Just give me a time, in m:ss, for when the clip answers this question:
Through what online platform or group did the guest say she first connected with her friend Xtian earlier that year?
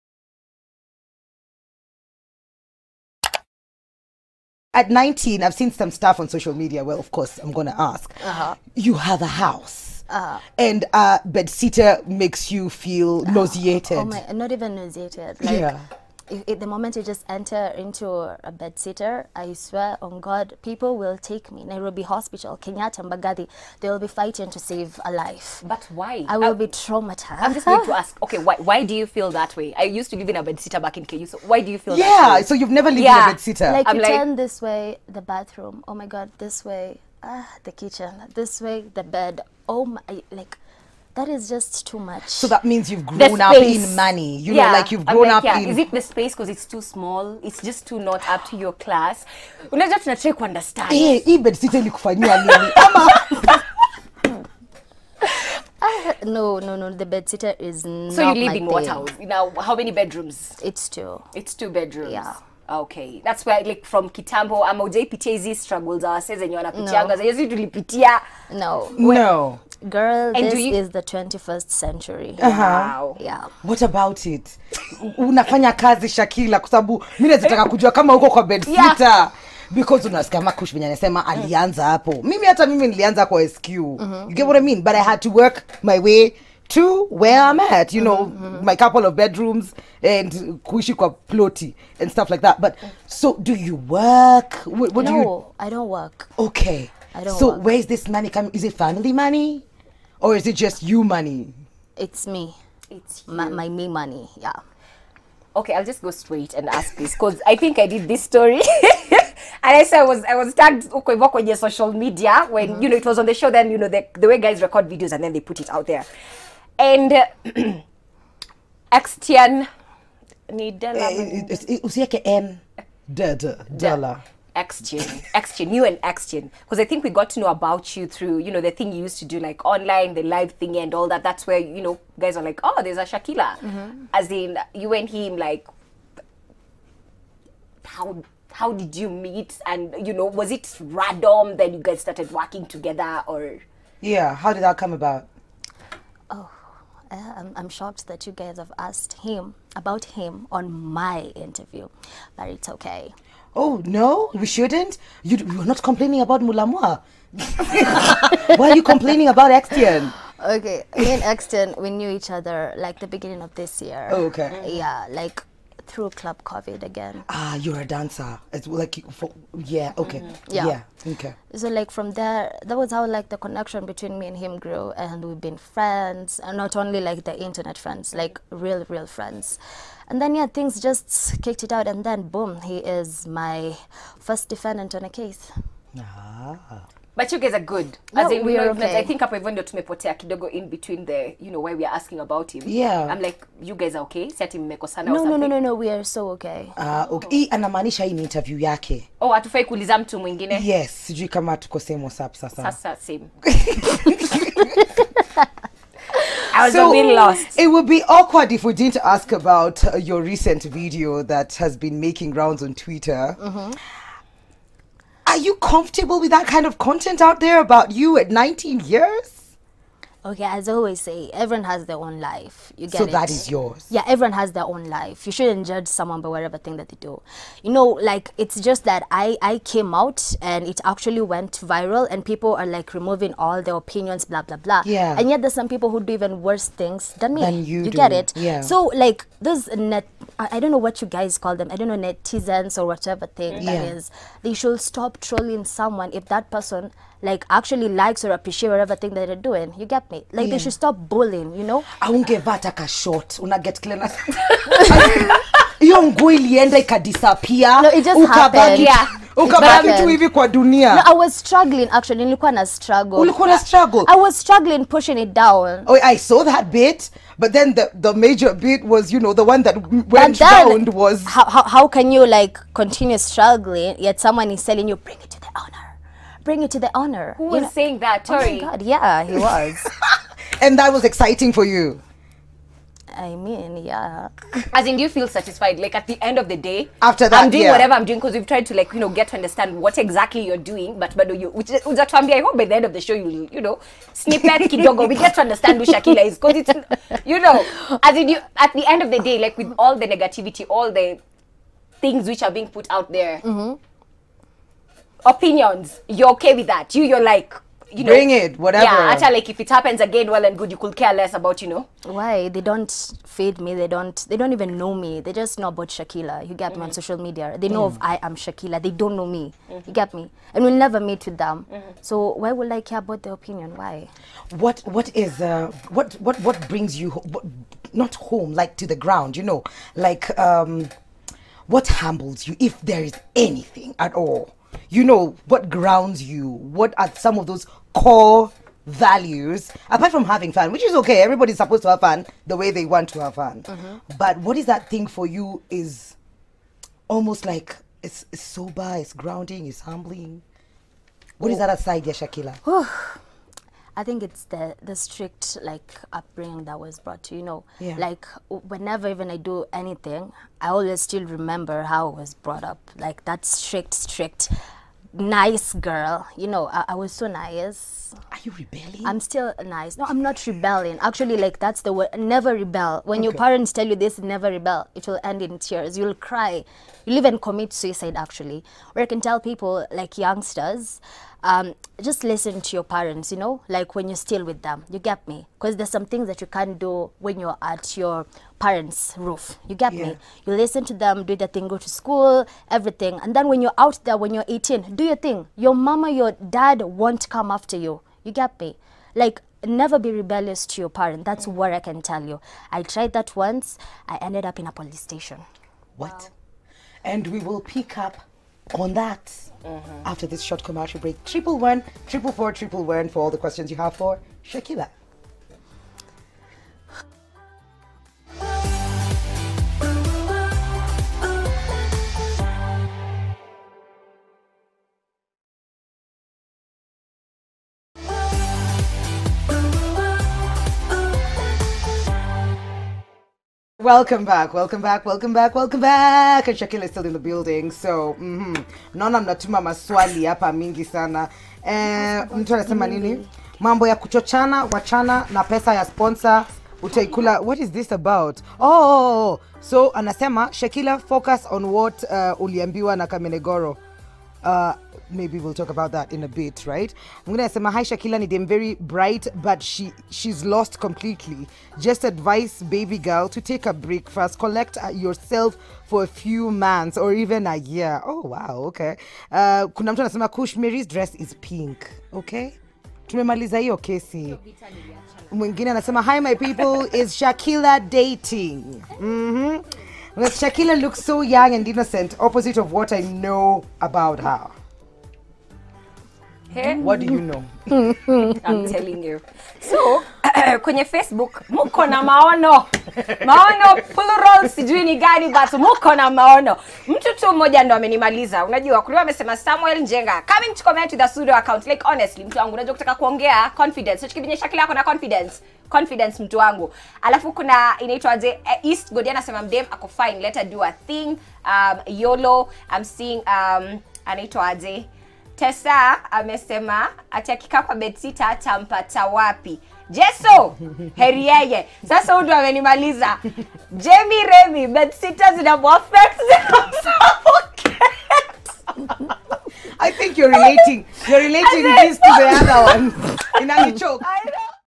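2:46.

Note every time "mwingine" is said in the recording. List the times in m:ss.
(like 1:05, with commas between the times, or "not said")
3:20, 7:37, 7:55.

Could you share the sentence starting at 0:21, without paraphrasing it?
Nairobi Hospital, Kenyatta, Mbagathi, they will be fighting to save a life.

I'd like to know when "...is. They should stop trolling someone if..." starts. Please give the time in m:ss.
4:03.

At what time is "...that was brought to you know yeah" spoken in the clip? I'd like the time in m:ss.
5:56.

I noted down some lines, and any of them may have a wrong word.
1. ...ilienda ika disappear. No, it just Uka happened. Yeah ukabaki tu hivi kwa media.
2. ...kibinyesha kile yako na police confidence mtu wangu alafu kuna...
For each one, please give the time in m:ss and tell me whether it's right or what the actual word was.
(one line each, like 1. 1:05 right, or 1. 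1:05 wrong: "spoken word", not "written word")
1. 4:16 wrong: "dunia", not "media"
2. 8:24 wrong: "confidence", not "police".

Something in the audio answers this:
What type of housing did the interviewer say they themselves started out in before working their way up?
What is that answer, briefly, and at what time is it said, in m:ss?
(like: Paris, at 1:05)
SQ, at 1:23.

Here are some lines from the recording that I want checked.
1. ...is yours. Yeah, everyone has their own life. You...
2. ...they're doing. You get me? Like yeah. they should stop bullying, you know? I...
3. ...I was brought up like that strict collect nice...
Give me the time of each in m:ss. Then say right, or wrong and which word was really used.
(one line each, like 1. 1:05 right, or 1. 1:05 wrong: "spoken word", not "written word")
1. 3:43 right
2. 4:09 right
3. 6:02 wrong: "strict", not "collect".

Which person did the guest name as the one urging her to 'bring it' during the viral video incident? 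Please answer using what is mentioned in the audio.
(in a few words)
Tori.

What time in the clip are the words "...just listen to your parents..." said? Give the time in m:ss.
6:22.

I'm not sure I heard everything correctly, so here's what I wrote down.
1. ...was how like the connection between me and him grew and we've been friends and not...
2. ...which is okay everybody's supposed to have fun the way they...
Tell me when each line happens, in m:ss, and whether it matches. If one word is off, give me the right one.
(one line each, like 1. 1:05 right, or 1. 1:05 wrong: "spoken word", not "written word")
1. 2:52 right
2. 5:40 right.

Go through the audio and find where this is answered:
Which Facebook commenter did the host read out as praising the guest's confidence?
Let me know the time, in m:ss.
8:19.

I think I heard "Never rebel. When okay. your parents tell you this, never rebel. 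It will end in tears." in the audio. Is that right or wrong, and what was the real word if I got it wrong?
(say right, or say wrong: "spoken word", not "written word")
right.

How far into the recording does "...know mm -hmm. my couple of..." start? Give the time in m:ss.
1:28.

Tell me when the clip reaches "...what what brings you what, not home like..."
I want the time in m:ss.
5:26.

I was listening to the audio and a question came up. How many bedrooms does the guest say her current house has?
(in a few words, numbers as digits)
2.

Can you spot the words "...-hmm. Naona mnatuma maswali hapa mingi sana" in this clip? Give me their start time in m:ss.
7:18.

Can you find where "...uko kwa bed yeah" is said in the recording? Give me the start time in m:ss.
1:18.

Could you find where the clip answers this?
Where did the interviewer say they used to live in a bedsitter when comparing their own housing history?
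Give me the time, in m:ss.
0:31.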